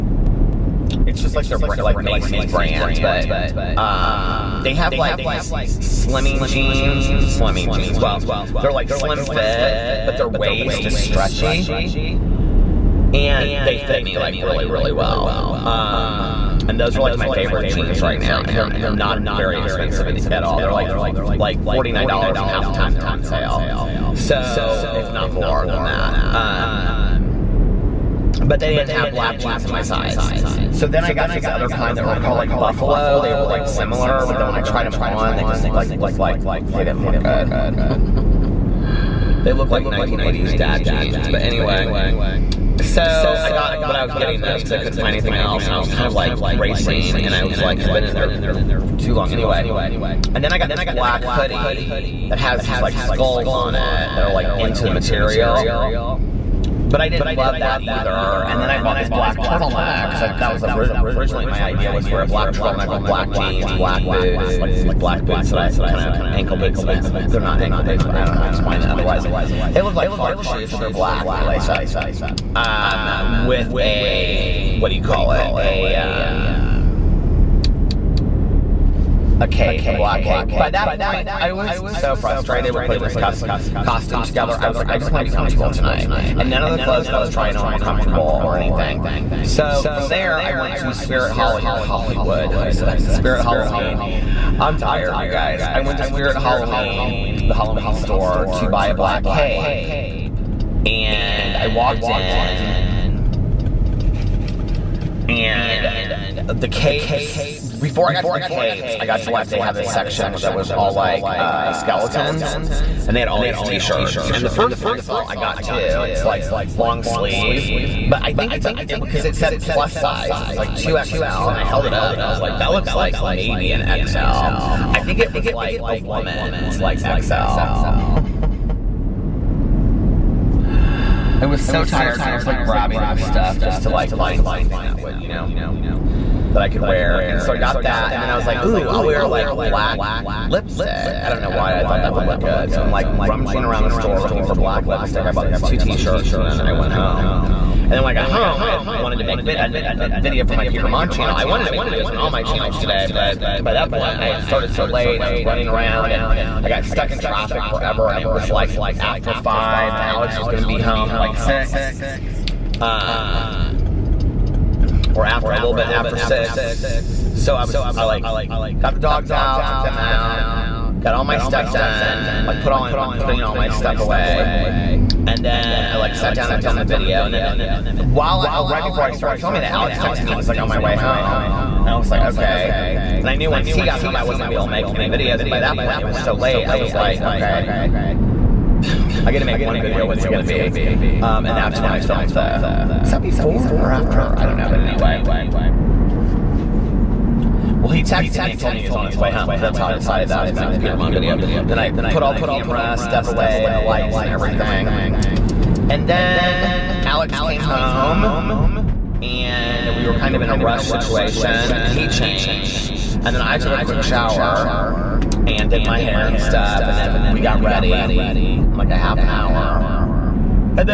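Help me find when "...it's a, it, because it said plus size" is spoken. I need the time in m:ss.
1:58.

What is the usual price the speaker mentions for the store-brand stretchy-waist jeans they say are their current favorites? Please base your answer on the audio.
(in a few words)
$49.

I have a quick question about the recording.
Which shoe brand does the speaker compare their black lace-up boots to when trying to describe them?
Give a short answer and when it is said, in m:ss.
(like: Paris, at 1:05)
Clark, at 1:10.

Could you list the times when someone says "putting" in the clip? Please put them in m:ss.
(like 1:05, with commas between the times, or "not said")
1:22, 2:53.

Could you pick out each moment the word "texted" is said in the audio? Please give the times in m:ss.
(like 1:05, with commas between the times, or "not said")
2:59, 3:18.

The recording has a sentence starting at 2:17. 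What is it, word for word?
And so I got that, and then I was like, ooh, I'll wear like black lipstick.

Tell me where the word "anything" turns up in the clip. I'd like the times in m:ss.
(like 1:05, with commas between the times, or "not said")
0:45, 1:28.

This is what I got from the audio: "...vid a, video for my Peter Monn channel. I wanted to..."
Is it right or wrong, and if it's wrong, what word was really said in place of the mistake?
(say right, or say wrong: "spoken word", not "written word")
right.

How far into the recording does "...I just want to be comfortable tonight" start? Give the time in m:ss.
1:24.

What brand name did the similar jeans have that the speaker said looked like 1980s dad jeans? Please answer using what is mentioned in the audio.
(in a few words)
Buffalo.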